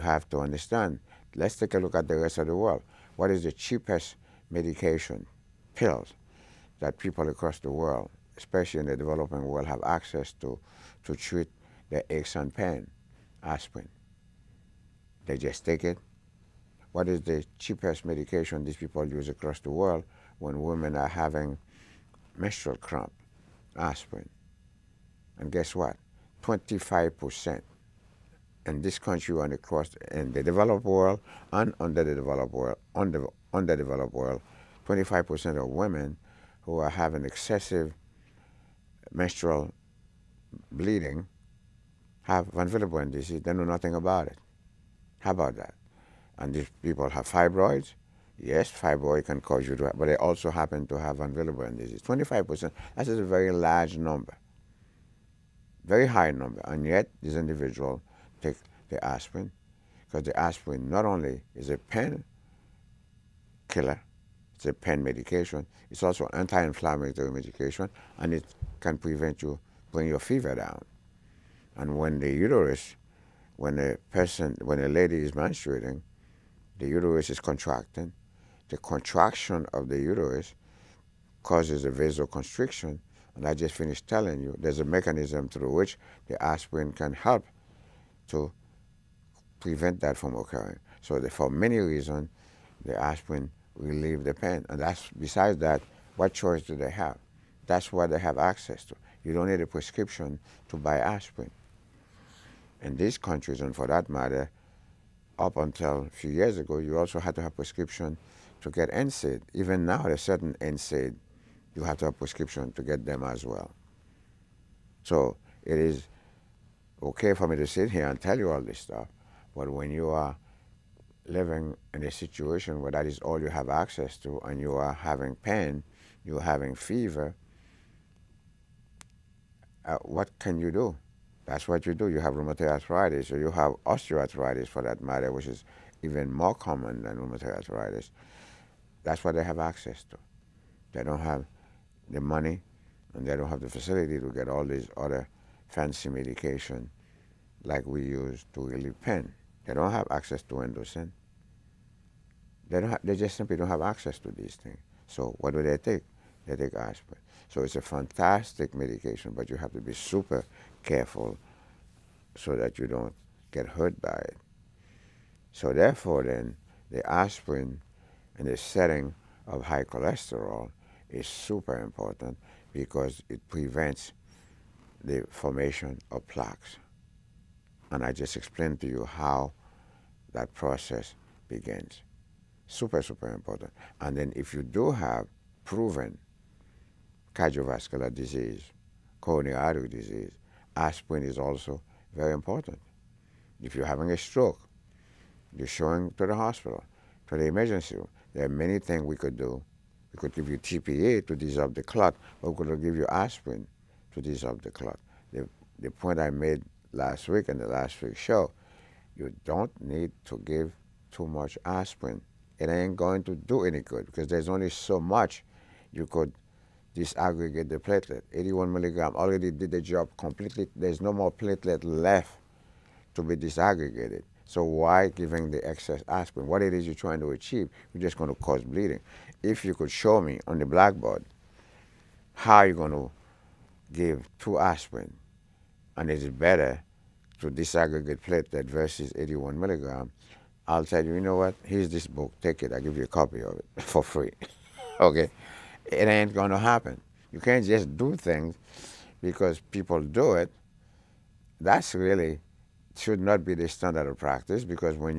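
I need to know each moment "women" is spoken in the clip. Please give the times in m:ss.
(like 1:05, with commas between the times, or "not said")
0:20, 0:35.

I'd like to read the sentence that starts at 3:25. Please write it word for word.
The, the point I made last week in the last week's show, you don't need to give too much aspirin.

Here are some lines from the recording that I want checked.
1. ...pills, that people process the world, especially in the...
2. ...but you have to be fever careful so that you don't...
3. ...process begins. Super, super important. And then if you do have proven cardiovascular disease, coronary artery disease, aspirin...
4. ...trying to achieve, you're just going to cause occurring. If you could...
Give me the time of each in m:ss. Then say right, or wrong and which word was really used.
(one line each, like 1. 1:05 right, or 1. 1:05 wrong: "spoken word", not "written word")
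1. 0:05 wrong: "across", not "process"
2. 2:39 wrong: "super", not "fever"
3. 3:00 right
4. 3:46 wrong: "bleeding", not "occurring".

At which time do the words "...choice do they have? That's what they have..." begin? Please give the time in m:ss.
1:36.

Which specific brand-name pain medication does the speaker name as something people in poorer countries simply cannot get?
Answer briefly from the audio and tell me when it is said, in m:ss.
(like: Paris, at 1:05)
Indocin, at 2:30.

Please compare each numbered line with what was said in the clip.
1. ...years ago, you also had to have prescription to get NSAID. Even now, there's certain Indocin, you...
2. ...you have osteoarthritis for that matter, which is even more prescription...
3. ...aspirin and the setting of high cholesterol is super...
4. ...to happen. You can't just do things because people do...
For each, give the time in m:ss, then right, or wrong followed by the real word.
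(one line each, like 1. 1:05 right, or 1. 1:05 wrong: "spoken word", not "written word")
1. 1:46 wrong: "NSAID", not "Indocin"
2. 2:13 wrong: "common", not "prescription"
3. 2:47 right
4. 4:06 right.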